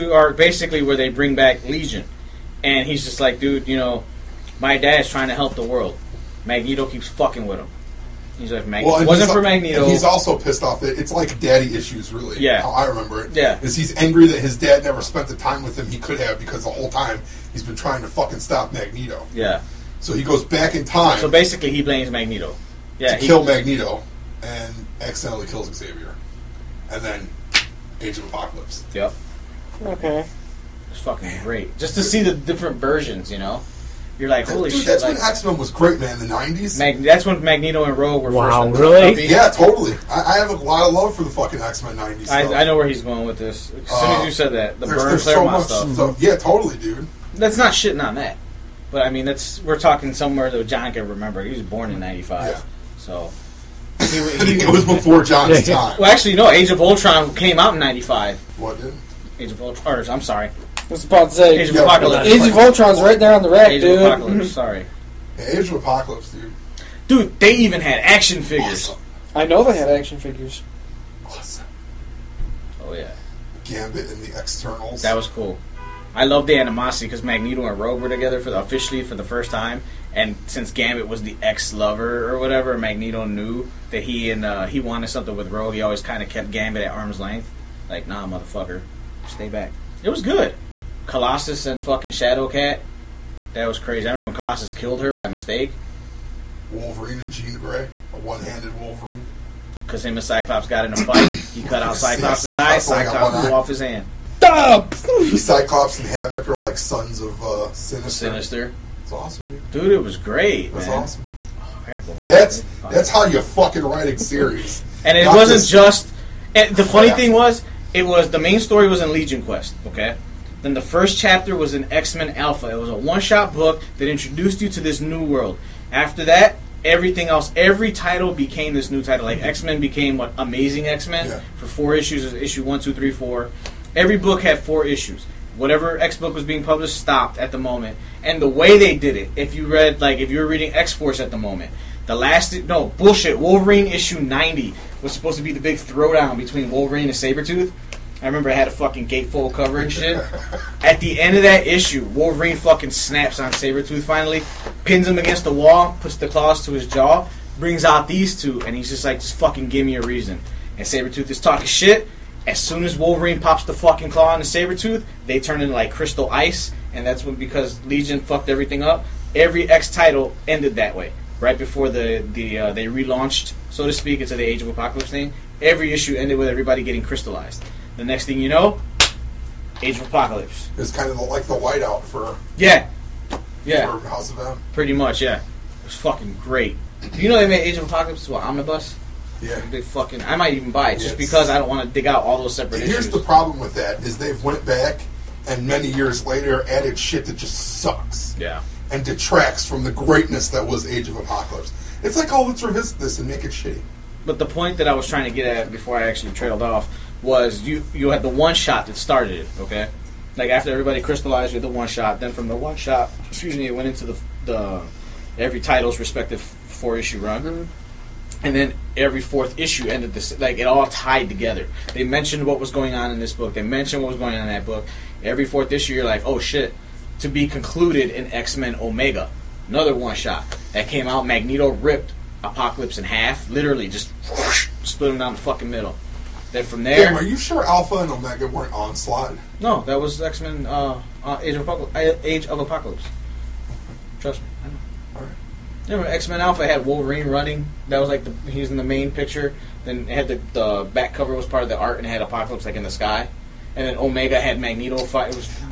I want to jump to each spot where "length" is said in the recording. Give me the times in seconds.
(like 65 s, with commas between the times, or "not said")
87 s.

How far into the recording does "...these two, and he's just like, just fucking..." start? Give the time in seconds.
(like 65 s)
158 s.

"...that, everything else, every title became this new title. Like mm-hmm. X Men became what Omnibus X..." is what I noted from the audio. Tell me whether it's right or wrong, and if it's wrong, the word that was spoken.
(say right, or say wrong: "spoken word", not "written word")
wrong: "Amazing", not "Omnibus".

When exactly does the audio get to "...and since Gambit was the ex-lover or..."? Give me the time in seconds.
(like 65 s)
80 s.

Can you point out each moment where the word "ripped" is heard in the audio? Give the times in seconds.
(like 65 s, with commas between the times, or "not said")
231 s.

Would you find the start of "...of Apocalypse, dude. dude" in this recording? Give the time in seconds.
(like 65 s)
65 s.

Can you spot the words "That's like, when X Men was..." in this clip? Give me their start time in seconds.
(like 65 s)
34 s.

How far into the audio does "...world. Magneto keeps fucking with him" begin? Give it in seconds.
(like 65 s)
5 s.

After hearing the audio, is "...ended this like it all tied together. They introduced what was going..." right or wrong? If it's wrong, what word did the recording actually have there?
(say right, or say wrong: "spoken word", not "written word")
wrong: "mentioned", not "introduced".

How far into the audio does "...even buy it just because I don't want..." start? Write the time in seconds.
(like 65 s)
190 s.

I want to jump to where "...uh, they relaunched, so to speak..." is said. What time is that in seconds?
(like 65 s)
172 s.